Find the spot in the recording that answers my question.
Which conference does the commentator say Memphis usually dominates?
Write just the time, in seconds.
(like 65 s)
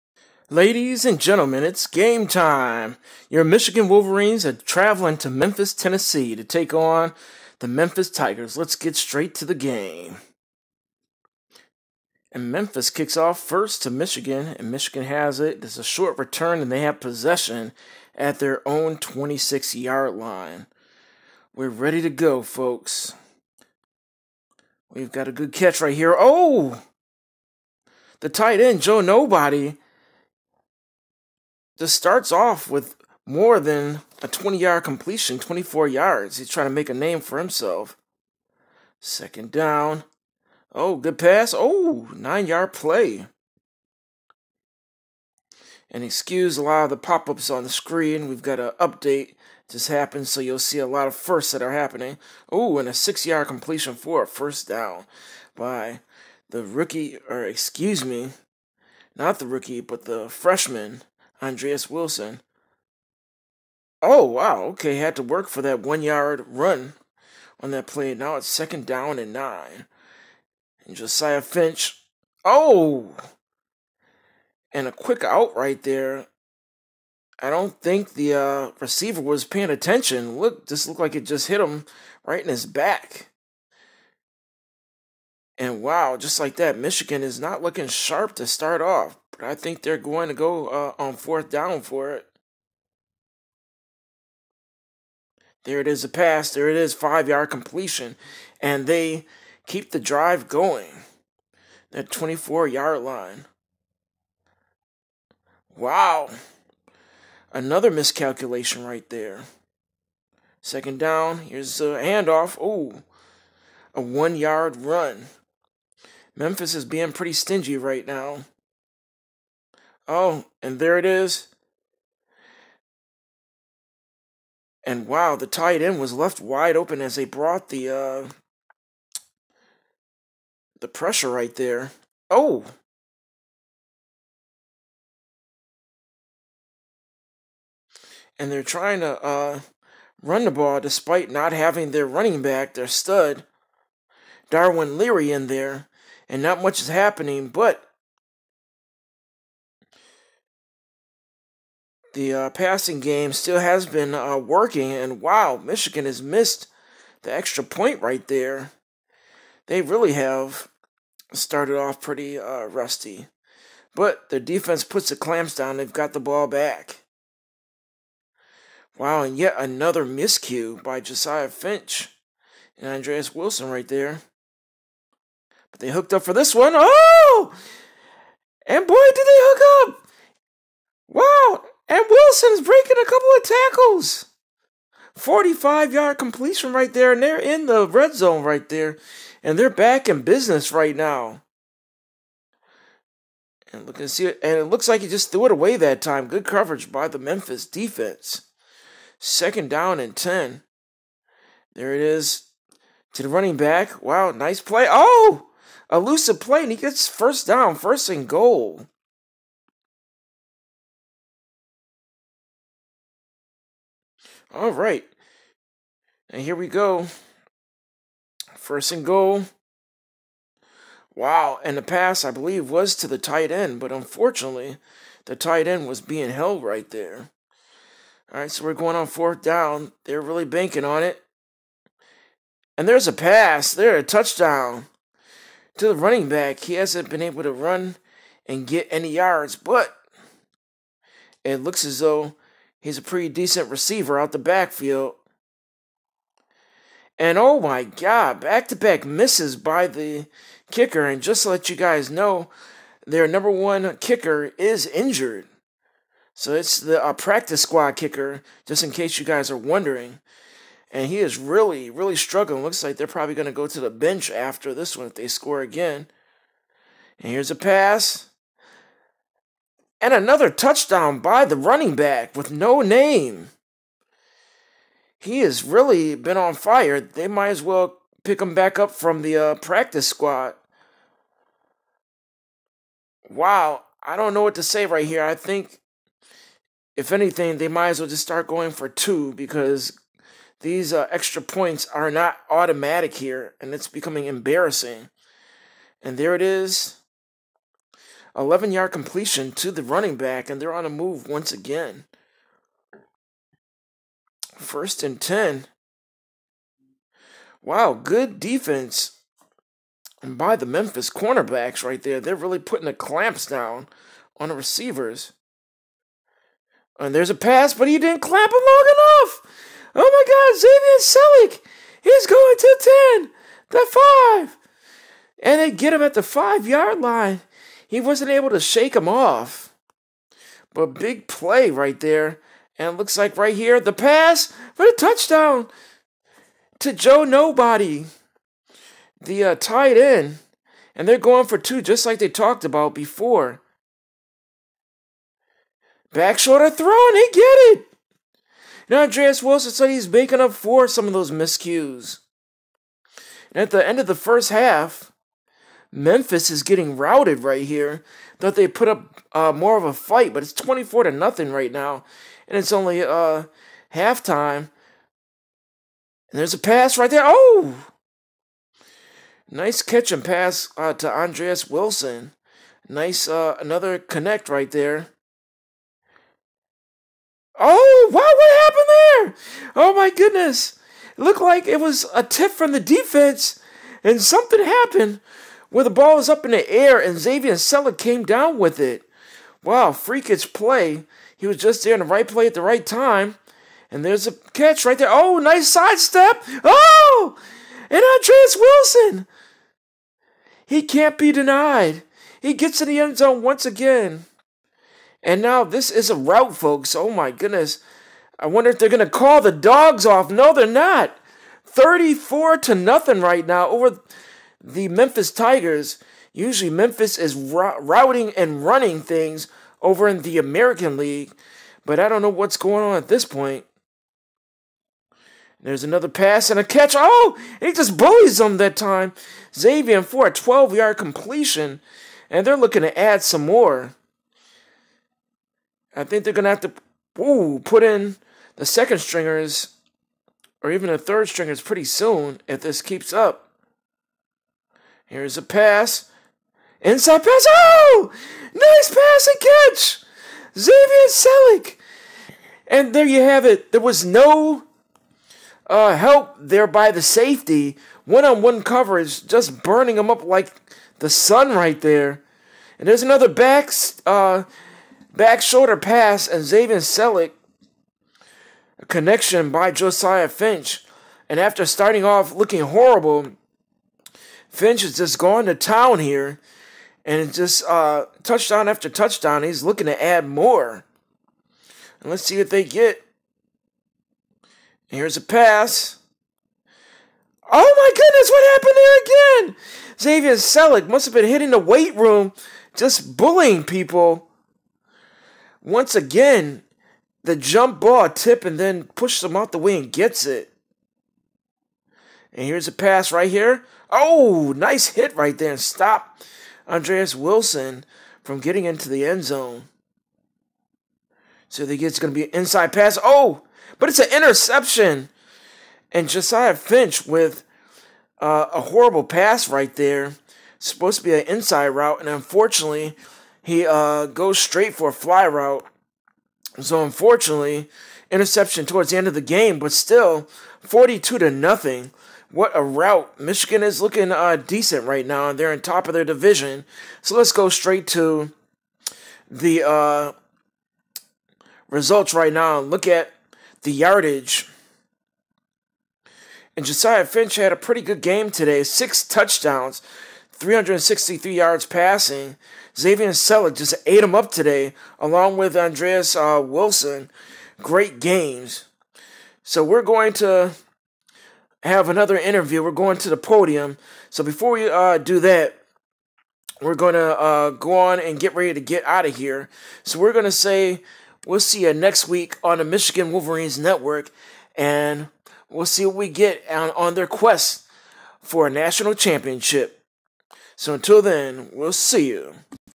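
420 s.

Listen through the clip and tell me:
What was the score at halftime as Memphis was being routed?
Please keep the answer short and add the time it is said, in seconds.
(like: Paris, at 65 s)
24 to 0, at 360 s.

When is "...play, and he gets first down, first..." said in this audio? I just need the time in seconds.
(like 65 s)
206 s.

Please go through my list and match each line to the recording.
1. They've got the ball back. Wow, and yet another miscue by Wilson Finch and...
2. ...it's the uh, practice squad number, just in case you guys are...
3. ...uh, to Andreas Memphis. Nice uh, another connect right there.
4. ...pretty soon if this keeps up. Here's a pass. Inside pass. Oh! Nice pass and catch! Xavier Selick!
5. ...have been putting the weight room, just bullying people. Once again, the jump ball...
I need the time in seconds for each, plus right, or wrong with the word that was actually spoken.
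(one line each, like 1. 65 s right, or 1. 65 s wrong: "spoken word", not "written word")
1. 165 s wrong: "Josiah", not "Wilson"
2. 256 s wrong: "kicker", not "number"
3. 370 s wrong: "Wilson", not "Memphis"
4. 441 s right
5. 491 s wrong: "hitting", not "putting".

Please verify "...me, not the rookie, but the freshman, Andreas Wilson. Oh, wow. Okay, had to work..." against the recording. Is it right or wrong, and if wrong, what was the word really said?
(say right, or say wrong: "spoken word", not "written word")
right.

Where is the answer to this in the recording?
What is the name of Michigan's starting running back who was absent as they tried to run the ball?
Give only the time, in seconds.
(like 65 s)
144 s.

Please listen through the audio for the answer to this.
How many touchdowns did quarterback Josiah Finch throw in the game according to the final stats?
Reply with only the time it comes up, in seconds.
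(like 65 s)
548 s.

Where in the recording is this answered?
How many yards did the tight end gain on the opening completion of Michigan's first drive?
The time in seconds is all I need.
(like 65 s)
35 s.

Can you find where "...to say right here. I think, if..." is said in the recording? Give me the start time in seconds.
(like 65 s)
284 s.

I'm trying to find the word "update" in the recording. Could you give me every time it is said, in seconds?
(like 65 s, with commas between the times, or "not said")
48 s.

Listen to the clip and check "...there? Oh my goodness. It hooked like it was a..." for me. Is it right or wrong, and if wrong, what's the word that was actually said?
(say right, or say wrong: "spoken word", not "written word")
wrong: "looked", not "hooked".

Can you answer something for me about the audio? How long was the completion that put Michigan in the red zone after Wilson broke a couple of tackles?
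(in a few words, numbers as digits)
45 yards.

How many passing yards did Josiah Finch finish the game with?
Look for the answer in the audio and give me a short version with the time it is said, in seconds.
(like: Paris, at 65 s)
363, at 550 s.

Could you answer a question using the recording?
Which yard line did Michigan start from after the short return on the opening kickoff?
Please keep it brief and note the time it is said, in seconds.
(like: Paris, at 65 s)
26, at 18 s.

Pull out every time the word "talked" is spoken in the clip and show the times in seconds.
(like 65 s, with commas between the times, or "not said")
342 s.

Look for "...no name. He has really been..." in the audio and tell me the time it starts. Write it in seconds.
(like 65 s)
272 s.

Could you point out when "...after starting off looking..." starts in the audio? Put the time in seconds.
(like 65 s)
471 s.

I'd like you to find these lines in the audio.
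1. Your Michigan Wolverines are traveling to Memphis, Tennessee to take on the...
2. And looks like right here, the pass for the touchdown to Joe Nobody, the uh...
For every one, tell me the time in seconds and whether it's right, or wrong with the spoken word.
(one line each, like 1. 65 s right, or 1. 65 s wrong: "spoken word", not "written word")
1. 3 s right
2. 332 s right.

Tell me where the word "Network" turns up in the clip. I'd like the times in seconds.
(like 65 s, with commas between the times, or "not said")
573 s.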